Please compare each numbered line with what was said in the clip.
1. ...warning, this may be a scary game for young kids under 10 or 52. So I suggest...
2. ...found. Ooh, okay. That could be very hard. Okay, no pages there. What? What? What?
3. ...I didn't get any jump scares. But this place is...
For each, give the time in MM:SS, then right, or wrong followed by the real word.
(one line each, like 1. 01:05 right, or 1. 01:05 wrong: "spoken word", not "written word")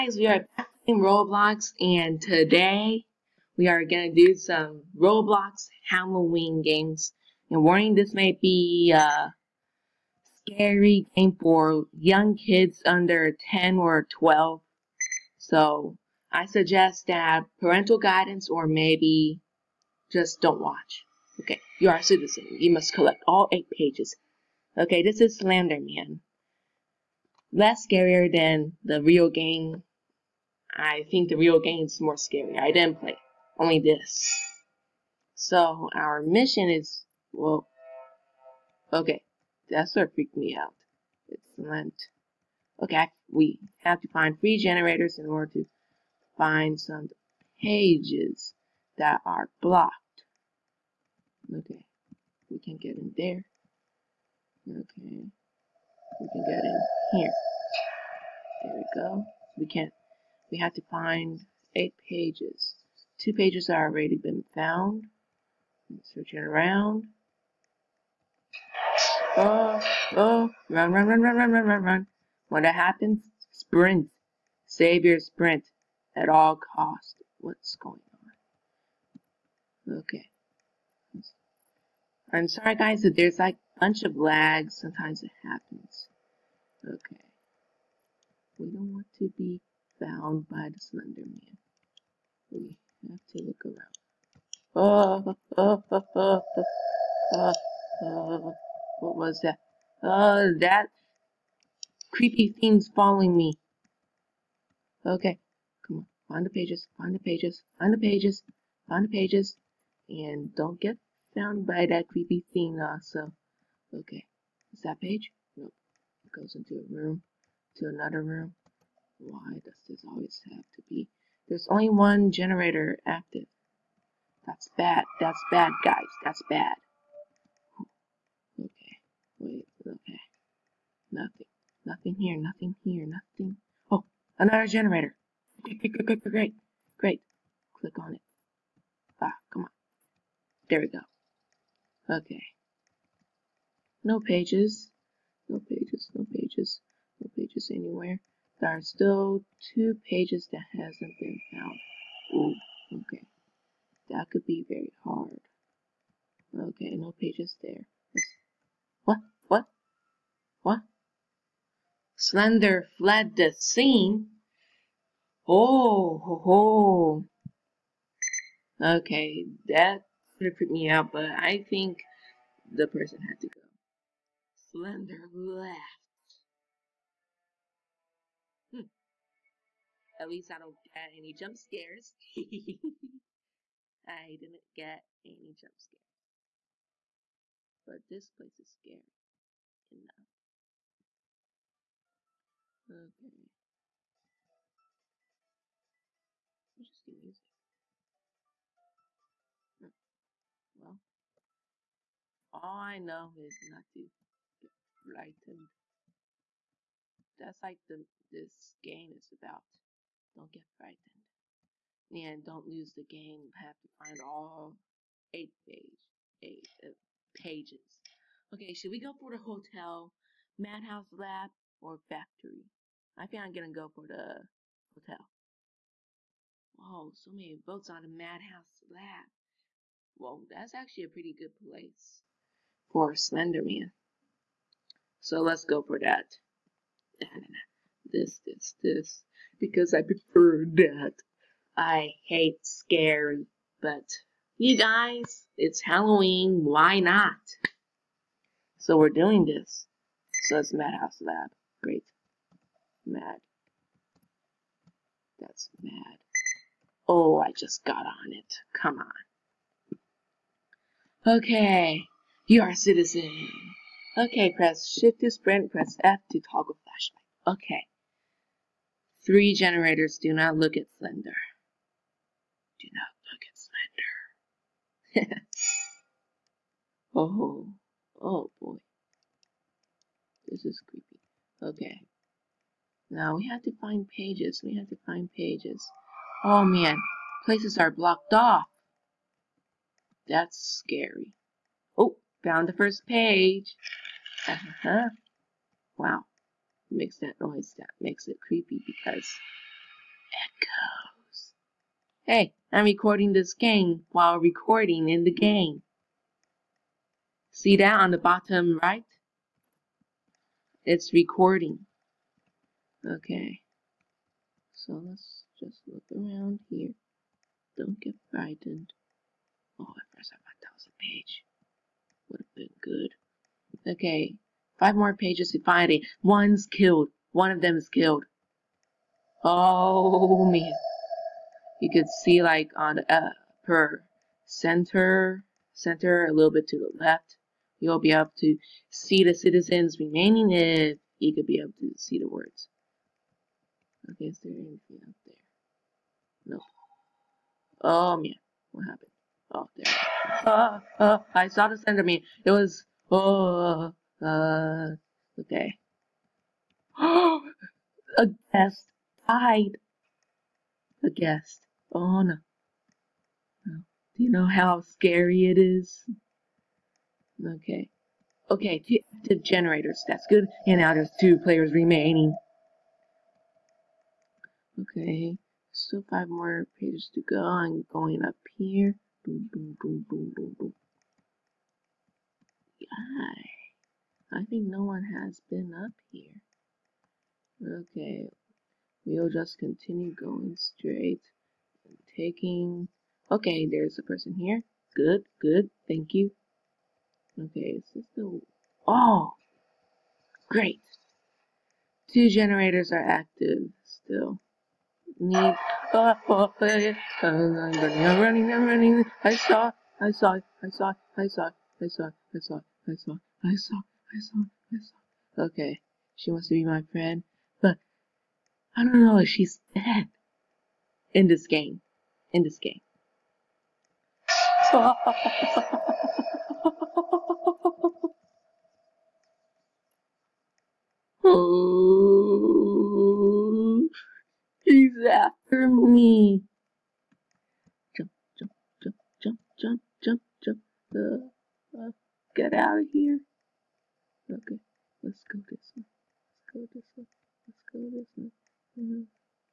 1. 00:07 wrong: "12", not "52"
2. 02:31 right
3. 03:04 right.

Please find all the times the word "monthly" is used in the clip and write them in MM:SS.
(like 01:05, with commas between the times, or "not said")
not said.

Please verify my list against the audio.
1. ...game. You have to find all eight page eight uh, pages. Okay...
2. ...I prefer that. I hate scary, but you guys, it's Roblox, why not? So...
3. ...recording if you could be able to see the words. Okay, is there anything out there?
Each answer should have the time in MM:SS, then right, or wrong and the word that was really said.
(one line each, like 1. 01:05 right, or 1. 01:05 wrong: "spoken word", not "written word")
1. 03:33 right
2. 03:59 wrong: "Halloween", not "Roblox"
3. 05:39 wrong: "remaining", not "recording".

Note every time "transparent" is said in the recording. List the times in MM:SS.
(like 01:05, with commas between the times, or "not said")
not said.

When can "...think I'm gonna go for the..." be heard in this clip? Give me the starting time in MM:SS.
03:43.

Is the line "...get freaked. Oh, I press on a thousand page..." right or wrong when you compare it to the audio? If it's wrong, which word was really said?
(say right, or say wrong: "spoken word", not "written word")
wrong: "frightened", not "freaked".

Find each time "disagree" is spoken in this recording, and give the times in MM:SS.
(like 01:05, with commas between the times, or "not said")
not said.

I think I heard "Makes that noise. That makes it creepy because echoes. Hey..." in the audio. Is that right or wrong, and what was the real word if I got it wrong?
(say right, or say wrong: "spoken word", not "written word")
right.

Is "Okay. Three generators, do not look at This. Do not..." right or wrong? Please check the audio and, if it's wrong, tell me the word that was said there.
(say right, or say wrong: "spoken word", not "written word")
wrong: "Slender", not "This".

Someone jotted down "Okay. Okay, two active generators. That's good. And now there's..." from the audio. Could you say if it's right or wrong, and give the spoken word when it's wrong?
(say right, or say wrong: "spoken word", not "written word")
right.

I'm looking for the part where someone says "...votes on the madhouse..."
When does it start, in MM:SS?
03:47.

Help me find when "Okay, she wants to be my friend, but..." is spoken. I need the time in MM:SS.
06:55.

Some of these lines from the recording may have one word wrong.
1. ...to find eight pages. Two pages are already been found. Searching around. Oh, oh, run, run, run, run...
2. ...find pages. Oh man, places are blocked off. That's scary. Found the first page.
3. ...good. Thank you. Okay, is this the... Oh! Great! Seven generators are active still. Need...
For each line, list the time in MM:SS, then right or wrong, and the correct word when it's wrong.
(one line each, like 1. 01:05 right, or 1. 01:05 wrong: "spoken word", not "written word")
1. 01:00 right
2. 04:45 right
3. 06:35 wrong: "Two", not "Seven".